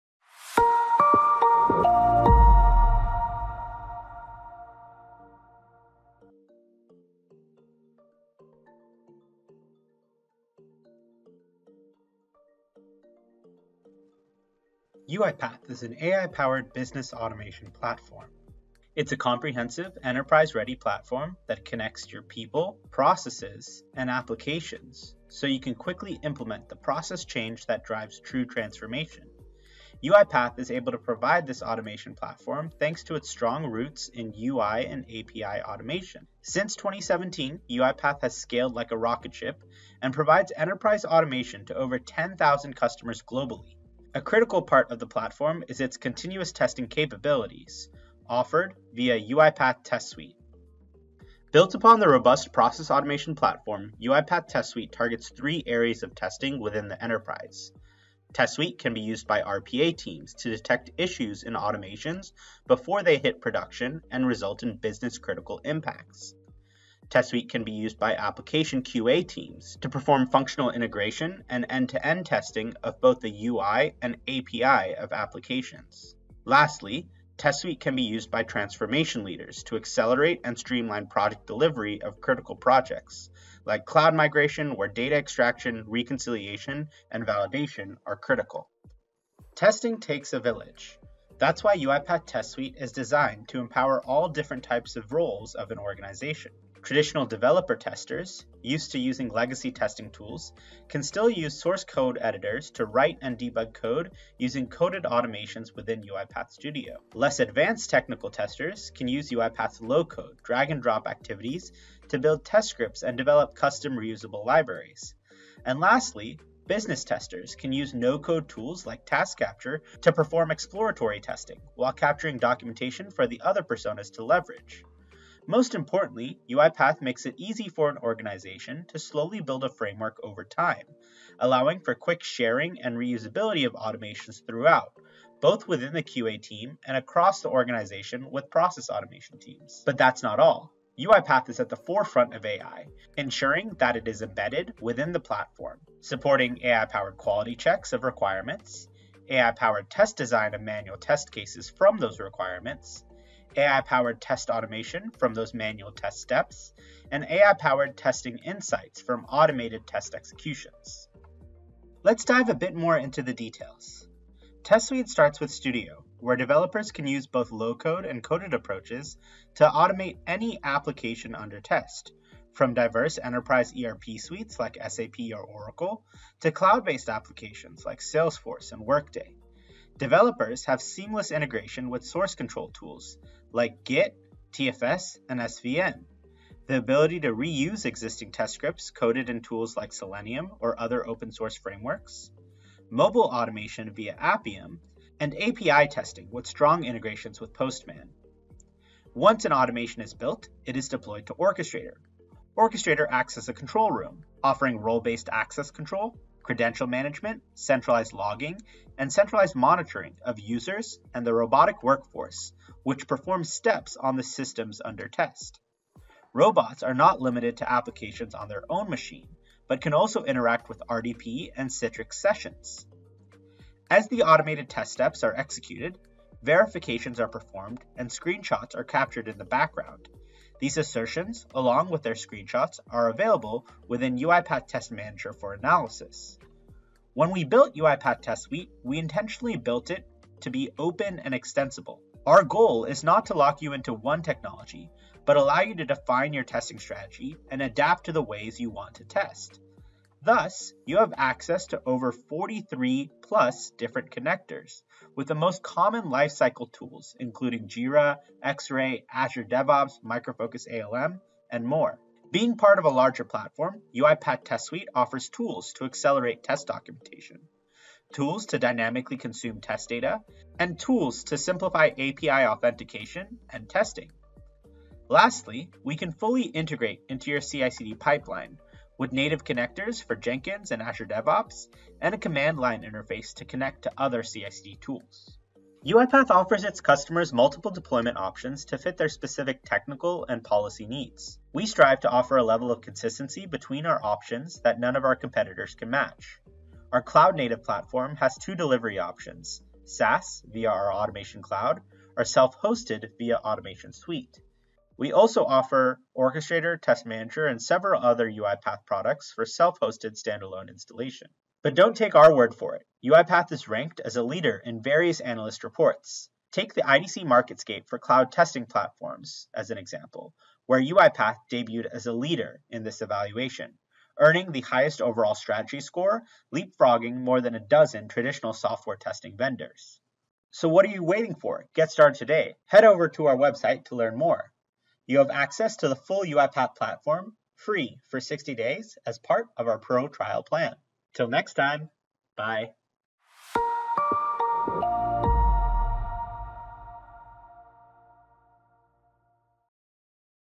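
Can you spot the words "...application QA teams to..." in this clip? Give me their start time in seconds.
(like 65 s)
68 s.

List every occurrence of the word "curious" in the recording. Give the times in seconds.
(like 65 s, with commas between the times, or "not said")
not said.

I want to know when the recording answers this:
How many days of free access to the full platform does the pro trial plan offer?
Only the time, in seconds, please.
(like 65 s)
338 s.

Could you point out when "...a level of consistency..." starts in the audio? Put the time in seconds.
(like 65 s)
292 s.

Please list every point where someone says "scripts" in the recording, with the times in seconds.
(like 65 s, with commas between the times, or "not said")
112 s, 188 s.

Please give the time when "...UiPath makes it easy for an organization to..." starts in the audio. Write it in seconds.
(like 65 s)
126 s.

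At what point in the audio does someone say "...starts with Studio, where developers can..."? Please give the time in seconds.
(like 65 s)
165 s.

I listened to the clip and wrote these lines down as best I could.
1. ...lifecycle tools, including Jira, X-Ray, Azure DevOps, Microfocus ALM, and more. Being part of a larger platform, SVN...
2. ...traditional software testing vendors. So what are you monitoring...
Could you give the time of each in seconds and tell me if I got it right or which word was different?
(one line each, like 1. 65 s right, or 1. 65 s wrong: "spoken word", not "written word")
1. 256 s wrong: "UiPath", not "SVN"
2. 328 s wrong: "waiting", not "monitoring".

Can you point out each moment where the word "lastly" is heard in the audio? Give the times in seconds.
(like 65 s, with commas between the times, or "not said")
76 s, 115 s, 275 s.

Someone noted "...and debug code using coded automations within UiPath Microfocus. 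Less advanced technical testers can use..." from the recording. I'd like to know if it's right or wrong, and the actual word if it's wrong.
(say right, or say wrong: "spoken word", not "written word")
wrong: "Studio", not "Microfocus".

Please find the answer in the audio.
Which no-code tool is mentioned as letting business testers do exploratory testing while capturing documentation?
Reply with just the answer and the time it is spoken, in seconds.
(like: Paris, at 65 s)
Task Capture, at 119 s.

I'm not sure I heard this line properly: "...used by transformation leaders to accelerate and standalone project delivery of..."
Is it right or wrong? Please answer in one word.
wrong.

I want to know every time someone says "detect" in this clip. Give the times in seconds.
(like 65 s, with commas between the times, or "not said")
60 s.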